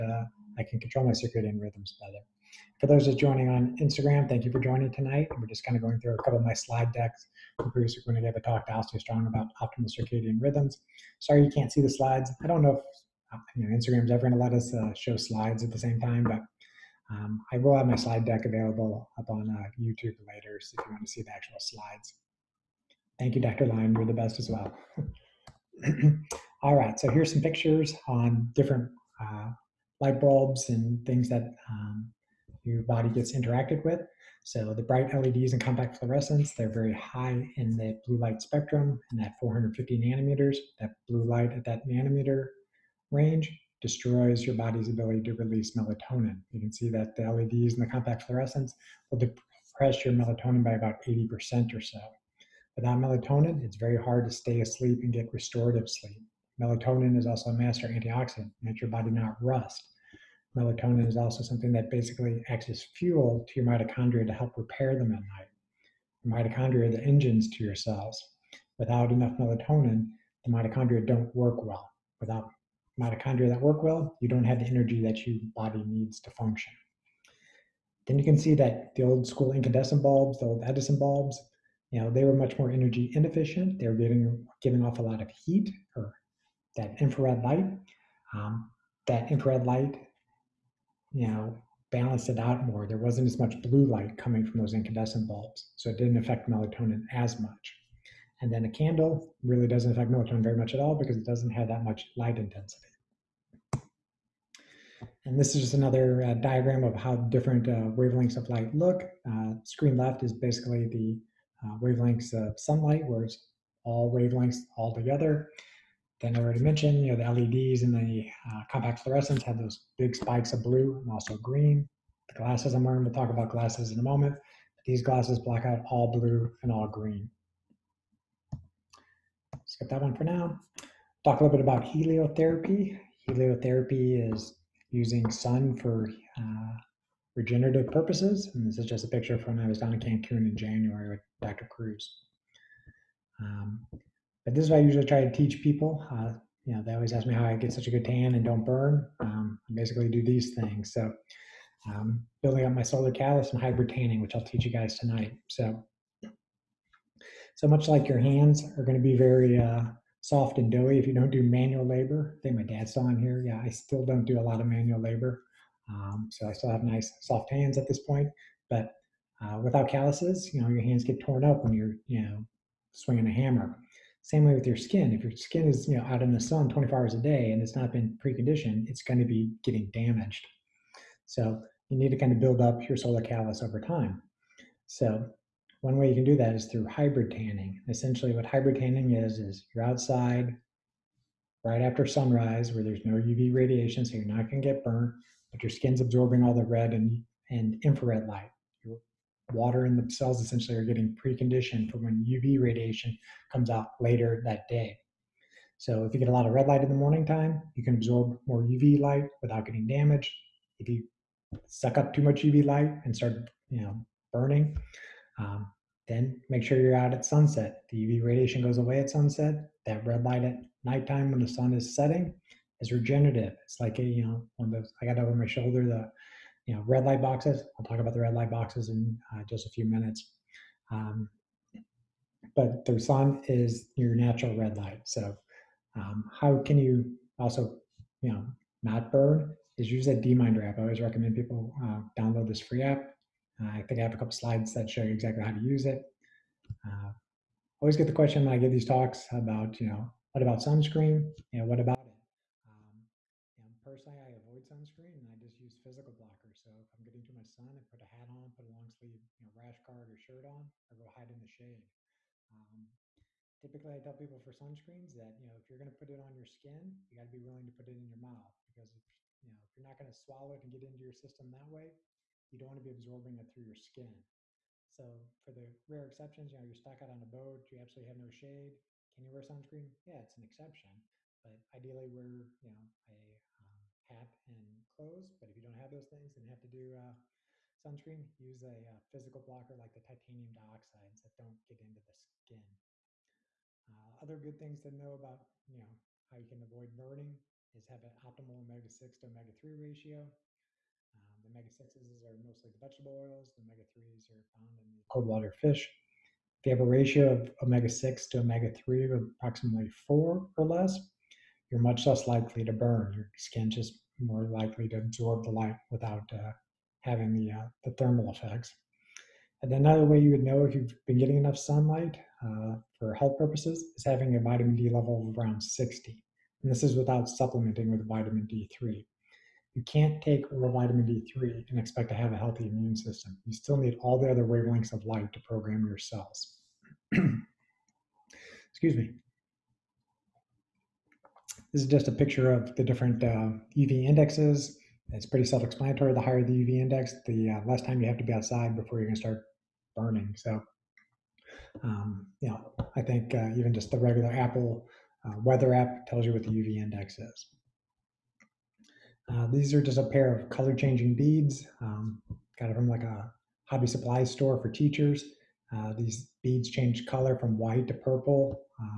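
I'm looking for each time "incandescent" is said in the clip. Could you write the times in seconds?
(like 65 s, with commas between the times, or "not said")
79 s, 94 s.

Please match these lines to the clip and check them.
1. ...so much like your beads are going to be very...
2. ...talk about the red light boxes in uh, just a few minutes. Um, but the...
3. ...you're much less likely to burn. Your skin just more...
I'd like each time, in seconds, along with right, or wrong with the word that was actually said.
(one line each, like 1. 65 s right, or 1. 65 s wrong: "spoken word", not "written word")
1. 157 s wrong: "hands", not "beads"
2. 227 s right
3. 311 s right.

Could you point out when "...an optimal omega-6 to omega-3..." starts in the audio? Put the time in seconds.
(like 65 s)
298 s.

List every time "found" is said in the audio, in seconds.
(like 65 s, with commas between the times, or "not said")
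304 s.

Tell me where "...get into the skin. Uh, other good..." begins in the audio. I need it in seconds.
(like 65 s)
291 s.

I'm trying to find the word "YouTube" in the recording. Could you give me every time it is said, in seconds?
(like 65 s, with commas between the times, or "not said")
19 s.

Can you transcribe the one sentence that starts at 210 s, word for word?
If you suck up too much UV light and start, you know, burning, um, then make sure you're out at sunset.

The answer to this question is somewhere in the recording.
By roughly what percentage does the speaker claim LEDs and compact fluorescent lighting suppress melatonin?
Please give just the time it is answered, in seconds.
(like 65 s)
50 s.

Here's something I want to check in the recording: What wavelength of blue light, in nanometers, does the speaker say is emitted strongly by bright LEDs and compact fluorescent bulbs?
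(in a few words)
450.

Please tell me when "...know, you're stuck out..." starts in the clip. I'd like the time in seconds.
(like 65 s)
276 s.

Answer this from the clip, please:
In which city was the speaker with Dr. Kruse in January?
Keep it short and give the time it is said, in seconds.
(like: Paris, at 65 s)
Cancun, at 139 s.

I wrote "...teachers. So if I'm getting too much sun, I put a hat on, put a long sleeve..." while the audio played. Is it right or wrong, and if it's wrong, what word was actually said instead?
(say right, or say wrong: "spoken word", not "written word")
wrong: "blockers", not "teachers".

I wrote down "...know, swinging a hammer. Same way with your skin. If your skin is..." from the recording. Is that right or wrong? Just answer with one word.
right.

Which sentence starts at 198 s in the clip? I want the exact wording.
Your water and the cells essentially are getting preconditioned for when UV radiation comes out later that day.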